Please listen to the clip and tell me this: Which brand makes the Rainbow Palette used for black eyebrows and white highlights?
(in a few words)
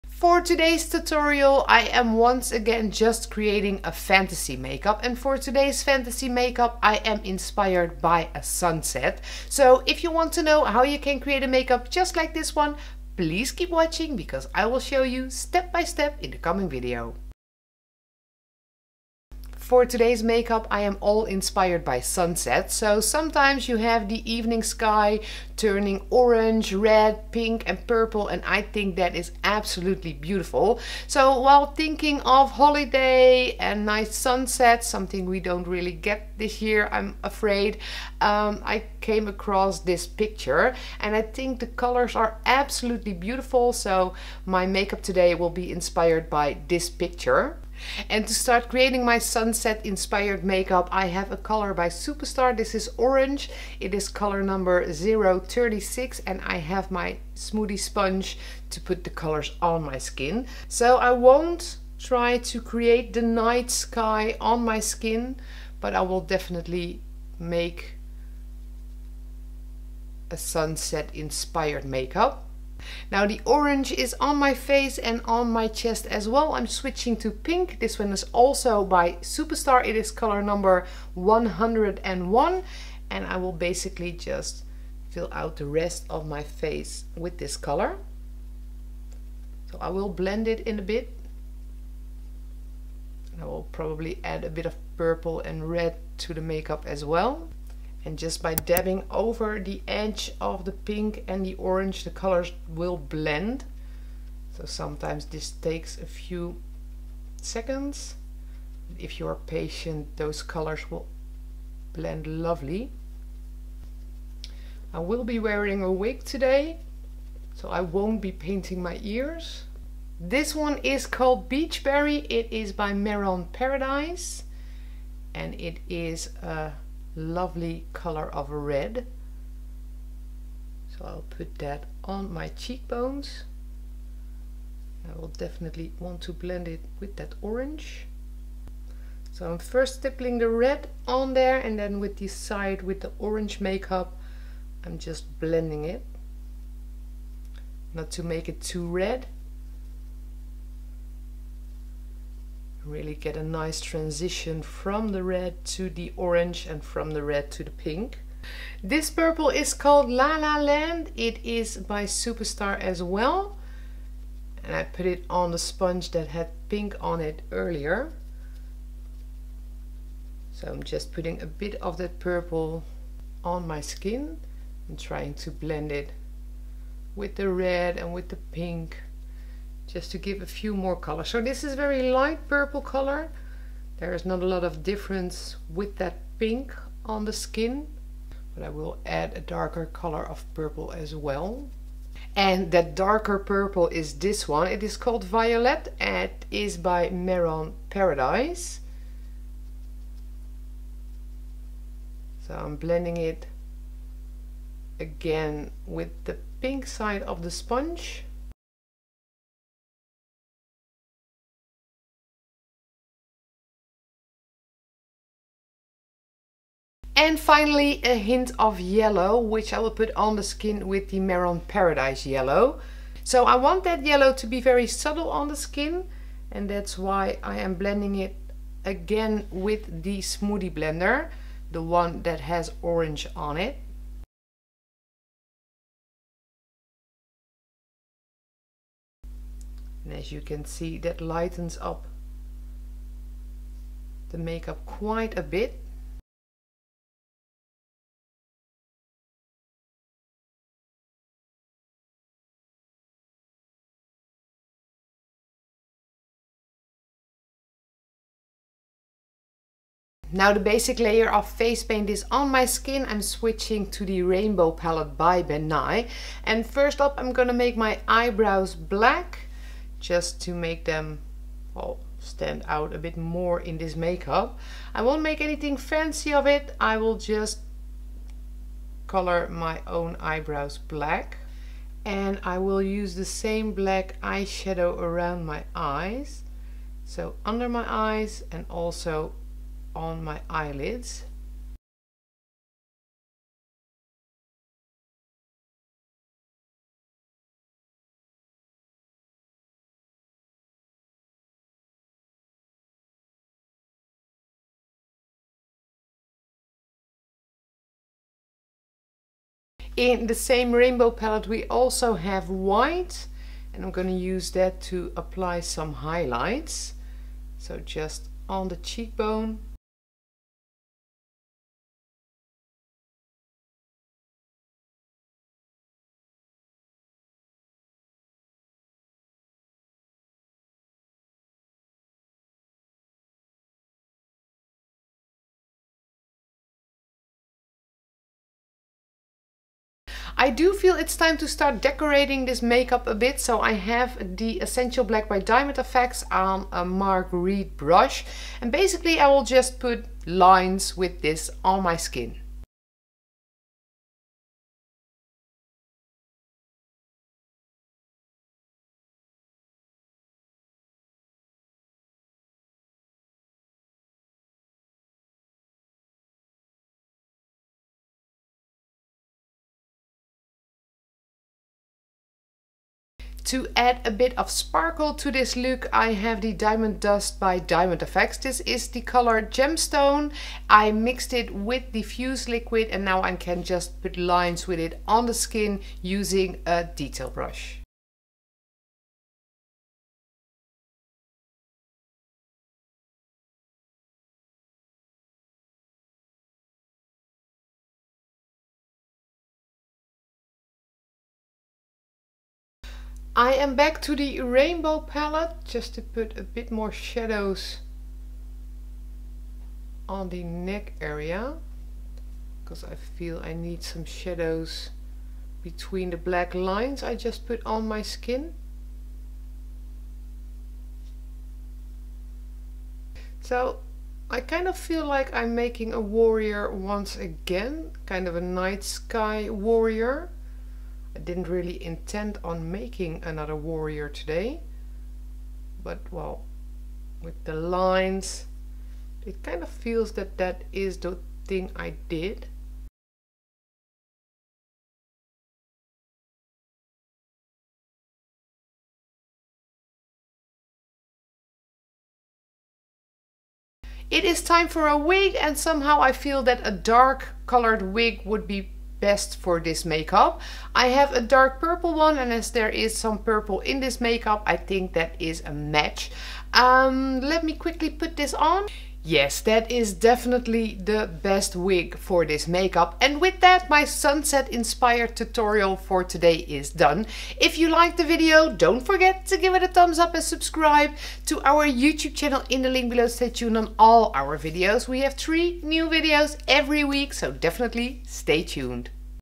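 Ben Nye.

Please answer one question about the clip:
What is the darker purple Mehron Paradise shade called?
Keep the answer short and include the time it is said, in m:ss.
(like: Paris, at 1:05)
Violet, at 3:15.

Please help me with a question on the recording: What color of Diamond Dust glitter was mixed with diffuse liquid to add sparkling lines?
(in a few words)
Goldstone.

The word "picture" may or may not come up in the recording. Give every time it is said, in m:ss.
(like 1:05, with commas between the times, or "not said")
0:40, 0:46.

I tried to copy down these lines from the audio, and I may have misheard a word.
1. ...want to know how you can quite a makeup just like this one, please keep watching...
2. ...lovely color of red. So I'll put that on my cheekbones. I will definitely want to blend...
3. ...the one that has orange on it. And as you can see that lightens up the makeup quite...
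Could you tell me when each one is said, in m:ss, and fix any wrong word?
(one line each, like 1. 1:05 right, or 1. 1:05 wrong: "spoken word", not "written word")
1. 0:10 wrong: "create", not "quite"
2. 2:07 right
3. 3:51 right.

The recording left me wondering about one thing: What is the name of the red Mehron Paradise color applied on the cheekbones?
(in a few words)
Beachberry.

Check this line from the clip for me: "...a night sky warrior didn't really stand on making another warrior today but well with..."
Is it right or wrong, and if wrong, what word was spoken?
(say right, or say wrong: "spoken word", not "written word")
wrong: "intend", not "stand".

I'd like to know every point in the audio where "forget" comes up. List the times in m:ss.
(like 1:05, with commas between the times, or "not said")
7:58.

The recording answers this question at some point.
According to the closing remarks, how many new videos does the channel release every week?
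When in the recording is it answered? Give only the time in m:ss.
8:05.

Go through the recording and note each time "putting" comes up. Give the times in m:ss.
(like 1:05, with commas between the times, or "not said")
2:51.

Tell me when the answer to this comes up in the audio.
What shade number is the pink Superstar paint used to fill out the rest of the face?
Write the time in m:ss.
1:21.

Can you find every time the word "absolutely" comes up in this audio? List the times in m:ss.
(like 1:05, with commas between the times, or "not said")
0:29, 0:42.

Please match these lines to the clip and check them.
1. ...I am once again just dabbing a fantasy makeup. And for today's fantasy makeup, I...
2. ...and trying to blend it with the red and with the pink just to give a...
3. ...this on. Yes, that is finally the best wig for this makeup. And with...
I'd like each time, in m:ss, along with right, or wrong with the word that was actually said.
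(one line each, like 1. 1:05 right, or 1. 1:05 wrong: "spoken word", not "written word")
1. 0:01 wrong: "creating", not "dabbing"
2. 2:54 right
3. 7:48 wrong: "definitely", not "finally".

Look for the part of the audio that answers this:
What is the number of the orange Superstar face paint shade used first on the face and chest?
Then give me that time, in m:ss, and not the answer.
0:54.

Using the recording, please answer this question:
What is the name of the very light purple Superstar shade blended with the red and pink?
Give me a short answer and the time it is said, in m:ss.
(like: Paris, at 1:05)
La La Land, at 2:40.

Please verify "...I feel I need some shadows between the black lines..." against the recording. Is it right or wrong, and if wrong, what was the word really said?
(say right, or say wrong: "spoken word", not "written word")
right.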